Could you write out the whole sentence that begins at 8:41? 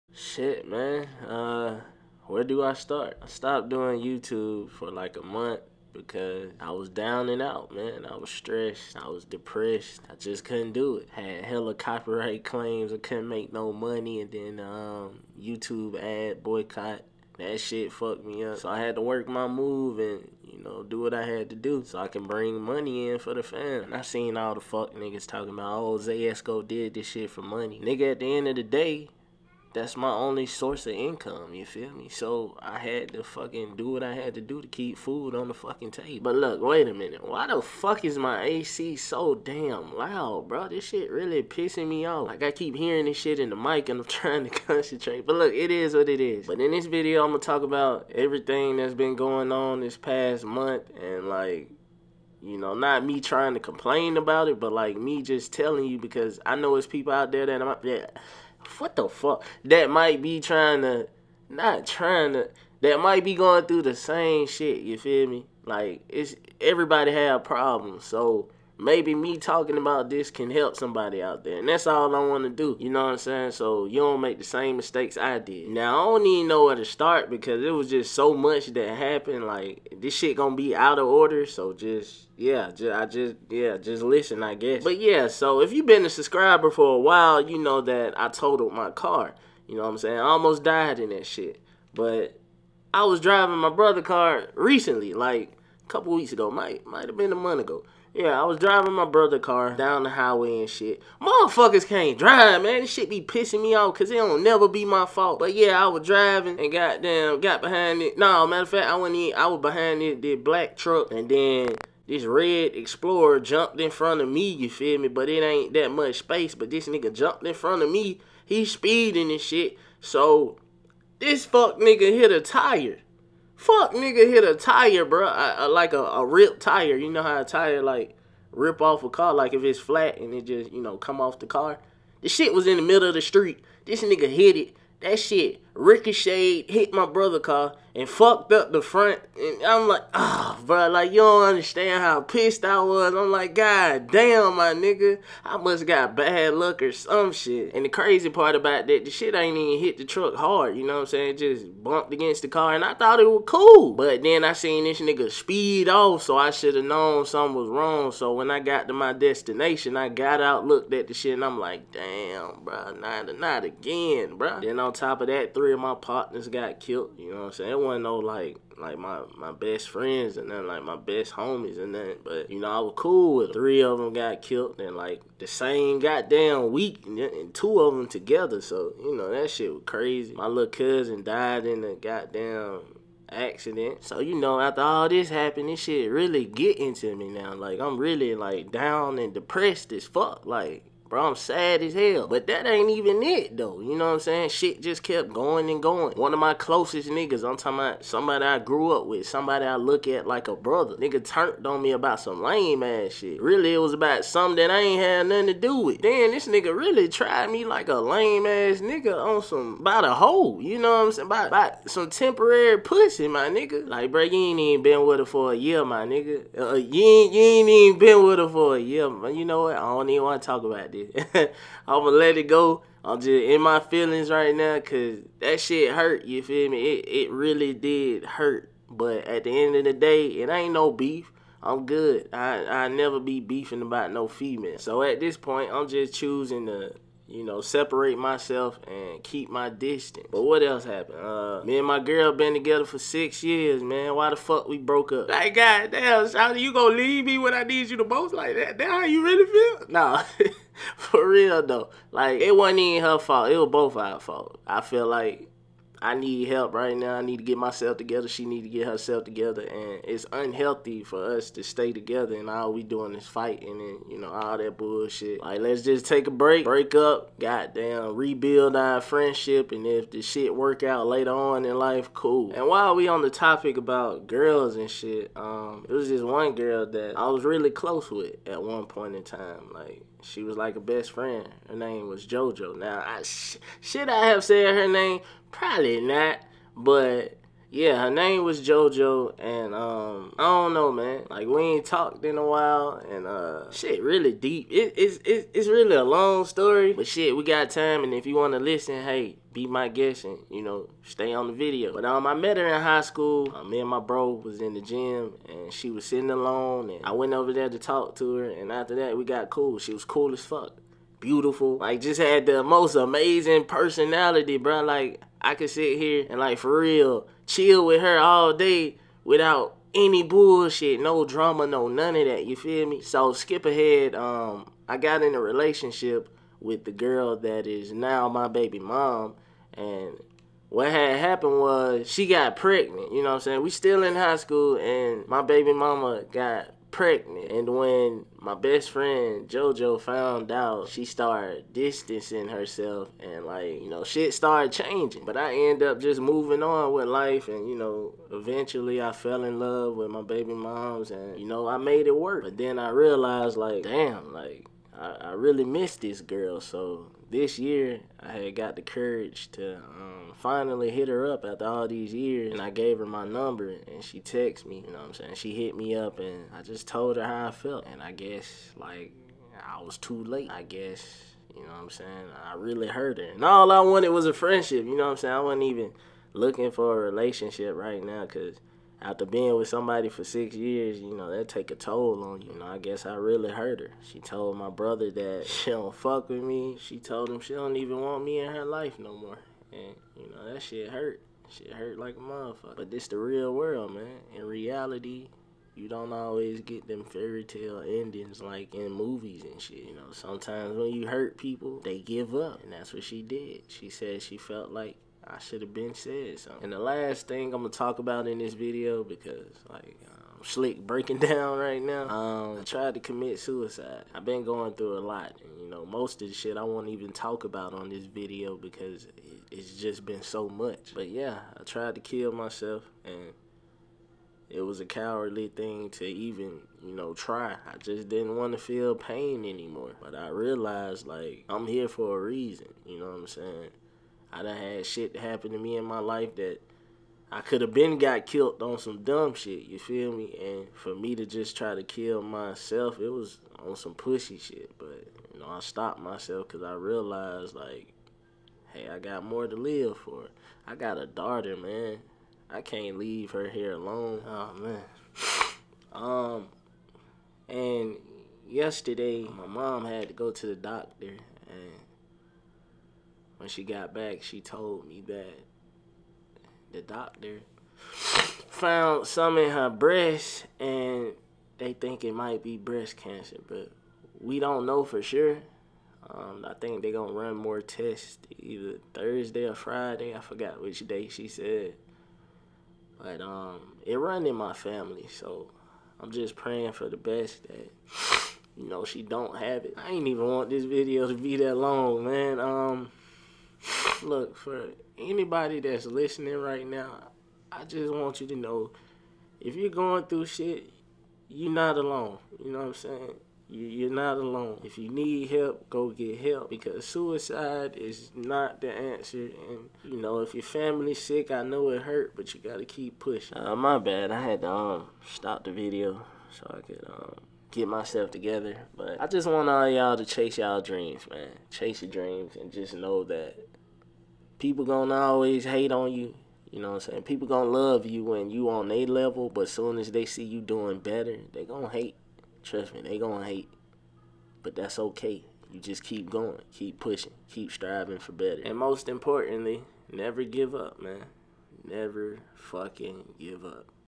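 Chase your dreams and just know that people gonna always hate on you.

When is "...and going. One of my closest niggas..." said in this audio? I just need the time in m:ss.
3:15.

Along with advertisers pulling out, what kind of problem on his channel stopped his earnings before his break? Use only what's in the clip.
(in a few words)
copyright claims.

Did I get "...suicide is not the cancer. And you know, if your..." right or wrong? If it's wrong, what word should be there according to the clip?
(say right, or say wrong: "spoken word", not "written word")
wrong: "answer", not "cancer".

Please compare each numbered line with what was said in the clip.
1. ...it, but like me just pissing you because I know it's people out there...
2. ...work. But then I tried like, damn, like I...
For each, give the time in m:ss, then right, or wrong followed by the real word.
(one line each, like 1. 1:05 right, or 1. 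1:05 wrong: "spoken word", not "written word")
1. 0:54 wrong: "telling", not "pissing"
2. 5:52 wrong: "realized", not "tried".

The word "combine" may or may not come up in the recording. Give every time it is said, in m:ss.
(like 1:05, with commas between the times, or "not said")
not said.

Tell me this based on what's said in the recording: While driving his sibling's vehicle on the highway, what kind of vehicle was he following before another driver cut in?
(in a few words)
black truck.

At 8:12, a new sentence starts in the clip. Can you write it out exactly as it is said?
Um, Look, for anybody that's listening right now, I just want you to know if you're going through shit, you're not alone.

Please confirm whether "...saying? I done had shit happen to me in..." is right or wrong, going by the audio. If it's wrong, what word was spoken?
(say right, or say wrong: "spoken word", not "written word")
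right.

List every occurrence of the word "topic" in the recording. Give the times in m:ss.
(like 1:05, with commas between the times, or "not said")
4:33.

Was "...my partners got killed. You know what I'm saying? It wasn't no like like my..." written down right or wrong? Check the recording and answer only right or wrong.
right.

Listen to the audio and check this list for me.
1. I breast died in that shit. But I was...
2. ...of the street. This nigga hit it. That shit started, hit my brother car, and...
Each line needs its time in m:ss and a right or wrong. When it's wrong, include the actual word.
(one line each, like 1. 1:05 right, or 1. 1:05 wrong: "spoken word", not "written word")
1. 1:30 wrong: "almost", not "breast"
2. 2:13 wrong: "ricocheted", not "started".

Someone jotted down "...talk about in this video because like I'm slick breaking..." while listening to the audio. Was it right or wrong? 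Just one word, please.
right.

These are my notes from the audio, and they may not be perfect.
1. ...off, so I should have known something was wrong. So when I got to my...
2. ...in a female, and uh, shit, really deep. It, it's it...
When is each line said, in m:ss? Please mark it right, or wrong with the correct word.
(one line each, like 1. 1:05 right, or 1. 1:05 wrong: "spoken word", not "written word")
1. 2:35 right
2. 4:52 wrong: "while", not "female".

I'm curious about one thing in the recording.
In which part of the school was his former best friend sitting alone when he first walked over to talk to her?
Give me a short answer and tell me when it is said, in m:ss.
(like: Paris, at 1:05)
the gym, at 5:04.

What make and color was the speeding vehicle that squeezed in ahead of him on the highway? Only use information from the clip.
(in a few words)
red Explorer.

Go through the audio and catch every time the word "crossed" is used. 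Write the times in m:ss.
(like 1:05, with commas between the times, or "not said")
not said.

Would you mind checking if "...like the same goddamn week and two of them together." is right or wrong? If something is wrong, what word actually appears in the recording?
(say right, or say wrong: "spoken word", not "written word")
right.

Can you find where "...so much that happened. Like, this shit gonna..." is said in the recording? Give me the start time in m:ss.
1:18.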